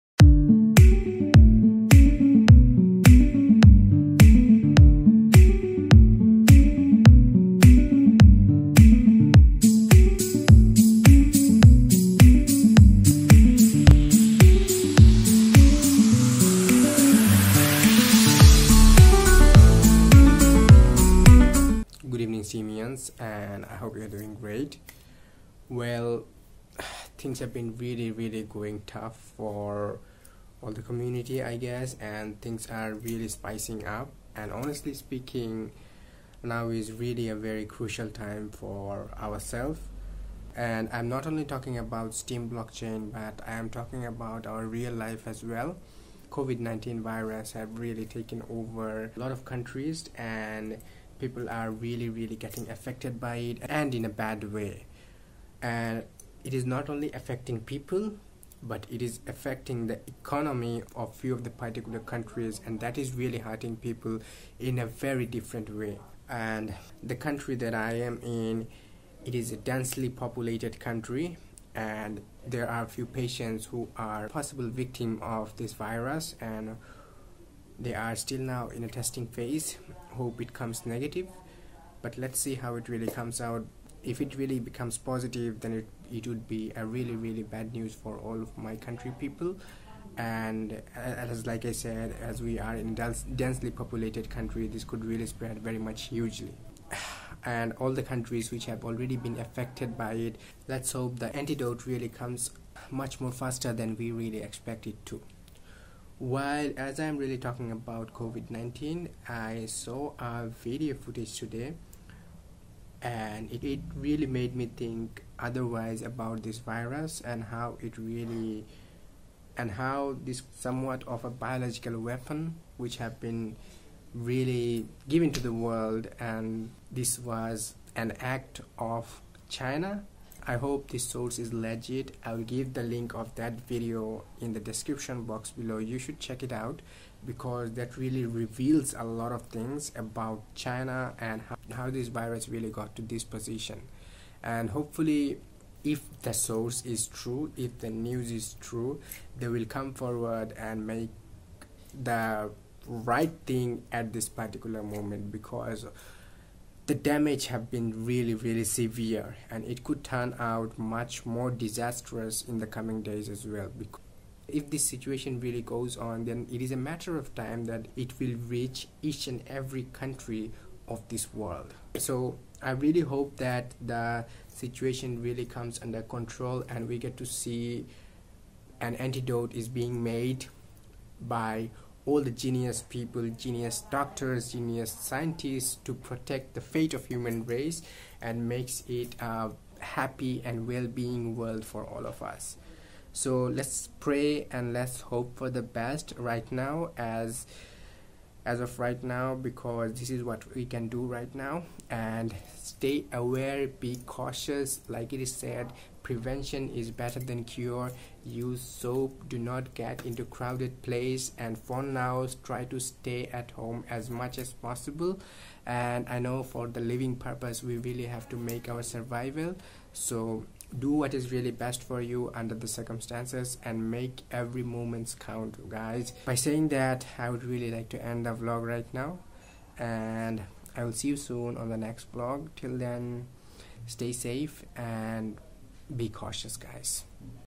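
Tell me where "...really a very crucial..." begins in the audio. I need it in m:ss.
0:36.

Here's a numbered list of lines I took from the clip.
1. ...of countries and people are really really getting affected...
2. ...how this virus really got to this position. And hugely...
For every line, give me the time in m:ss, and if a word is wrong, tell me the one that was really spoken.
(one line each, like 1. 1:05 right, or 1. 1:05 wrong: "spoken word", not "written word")
1. 0:49 right
2. 2:21 wrong: "hopefully", not "hugely".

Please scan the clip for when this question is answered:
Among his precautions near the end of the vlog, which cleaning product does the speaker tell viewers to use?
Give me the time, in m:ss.
3:28.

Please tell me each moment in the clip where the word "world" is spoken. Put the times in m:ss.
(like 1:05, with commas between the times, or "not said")
2:05, 2:51, 3:11.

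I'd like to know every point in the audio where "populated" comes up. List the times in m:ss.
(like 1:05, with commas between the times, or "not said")
1:10, 1:33.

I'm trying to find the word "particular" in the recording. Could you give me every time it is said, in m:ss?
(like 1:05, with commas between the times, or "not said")
1:01, 2:34.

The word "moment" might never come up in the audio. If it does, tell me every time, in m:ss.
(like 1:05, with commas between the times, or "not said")
2:34, 3:44.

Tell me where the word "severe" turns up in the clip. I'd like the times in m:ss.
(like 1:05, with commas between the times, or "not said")
2:38.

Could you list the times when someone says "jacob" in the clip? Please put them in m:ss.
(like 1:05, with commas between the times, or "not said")
not said.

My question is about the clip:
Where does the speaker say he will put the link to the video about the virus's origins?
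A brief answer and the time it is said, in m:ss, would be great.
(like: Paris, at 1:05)
The description box, at 2:14.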